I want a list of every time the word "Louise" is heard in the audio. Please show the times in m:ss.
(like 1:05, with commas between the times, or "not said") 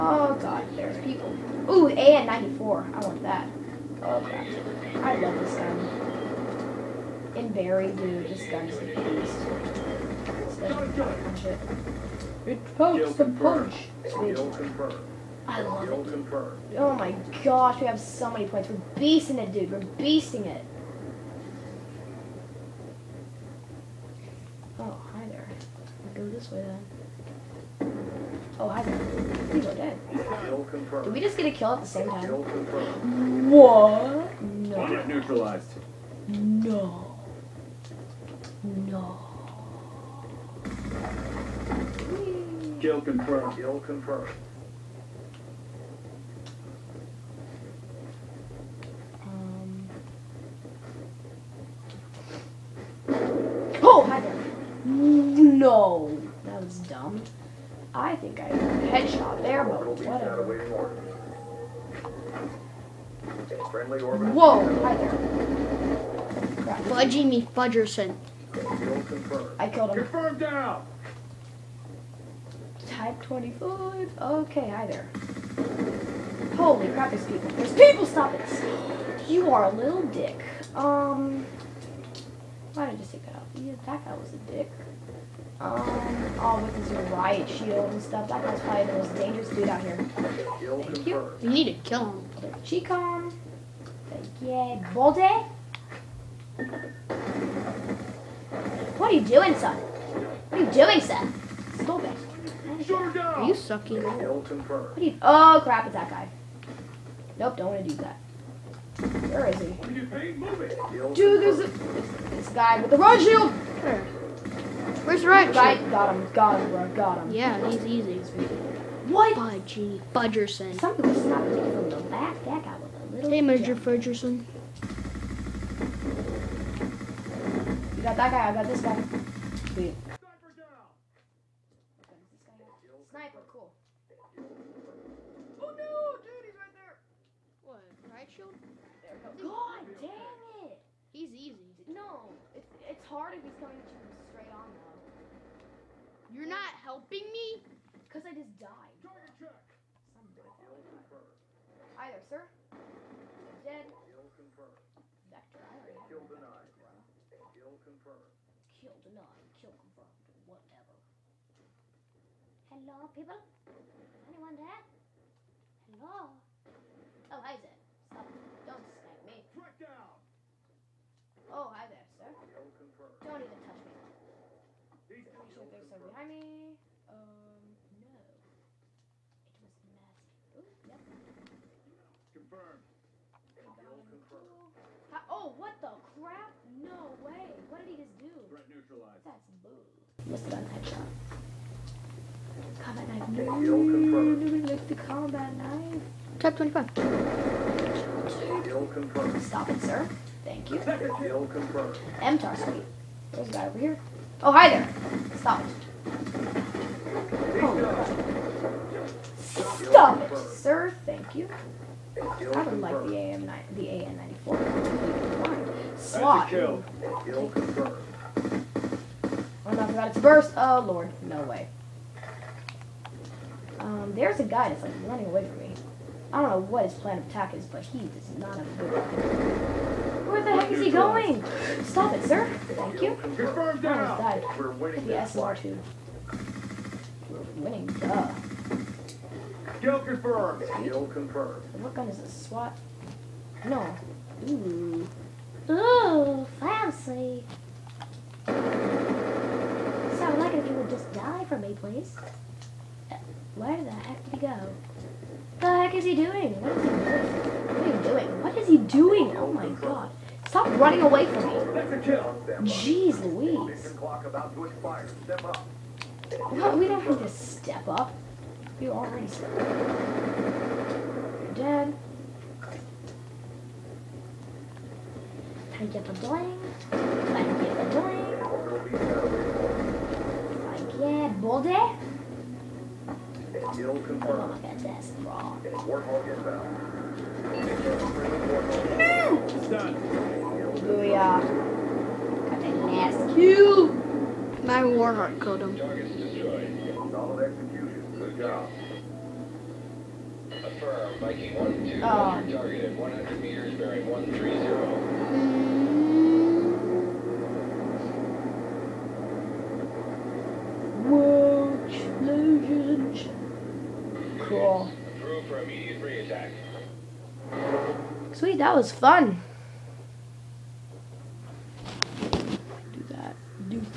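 4:23.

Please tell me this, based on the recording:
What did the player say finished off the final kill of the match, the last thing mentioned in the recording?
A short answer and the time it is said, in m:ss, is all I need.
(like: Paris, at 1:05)
Warhawk, at 4:54.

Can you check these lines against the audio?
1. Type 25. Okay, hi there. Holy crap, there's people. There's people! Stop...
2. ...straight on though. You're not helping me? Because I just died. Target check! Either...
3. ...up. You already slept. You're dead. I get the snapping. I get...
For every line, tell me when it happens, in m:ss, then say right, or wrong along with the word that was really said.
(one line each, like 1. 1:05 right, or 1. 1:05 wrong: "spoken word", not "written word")
1. 1:12 right
2. 2:24 right
3. 4:27 wrong: "bling", not "snapping".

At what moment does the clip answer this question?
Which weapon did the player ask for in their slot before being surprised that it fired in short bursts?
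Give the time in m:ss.
3:33.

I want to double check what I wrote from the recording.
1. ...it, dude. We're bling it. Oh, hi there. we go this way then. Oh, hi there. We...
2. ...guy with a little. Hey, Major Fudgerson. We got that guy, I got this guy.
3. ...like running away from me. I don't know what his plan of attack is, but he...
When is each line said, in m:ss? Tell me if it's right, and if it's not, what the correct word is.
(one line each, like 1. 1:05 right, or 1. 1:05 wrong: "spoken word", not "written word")
1. 0:19 wrong: "beasting", not "bling"
2. 2:02 right
3. 3:44 right.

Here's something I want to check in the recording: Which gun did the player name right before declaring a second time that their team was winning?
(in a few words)
SLR two.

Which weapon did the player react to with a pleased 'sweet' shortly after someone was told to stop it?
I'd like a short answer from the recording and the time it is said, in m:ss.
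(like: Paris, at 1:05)
MTAR, at 3:20.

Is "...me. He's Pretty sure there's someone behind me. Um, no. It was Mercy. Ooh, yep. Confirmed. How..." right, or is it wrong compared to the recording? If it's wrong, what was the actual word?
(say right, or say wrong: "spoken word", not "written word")
right.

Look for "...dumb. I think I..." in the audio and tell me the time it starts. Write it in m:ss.
0:56.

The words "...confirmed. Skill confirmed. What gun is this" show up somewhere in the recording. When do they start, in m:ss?
3:59.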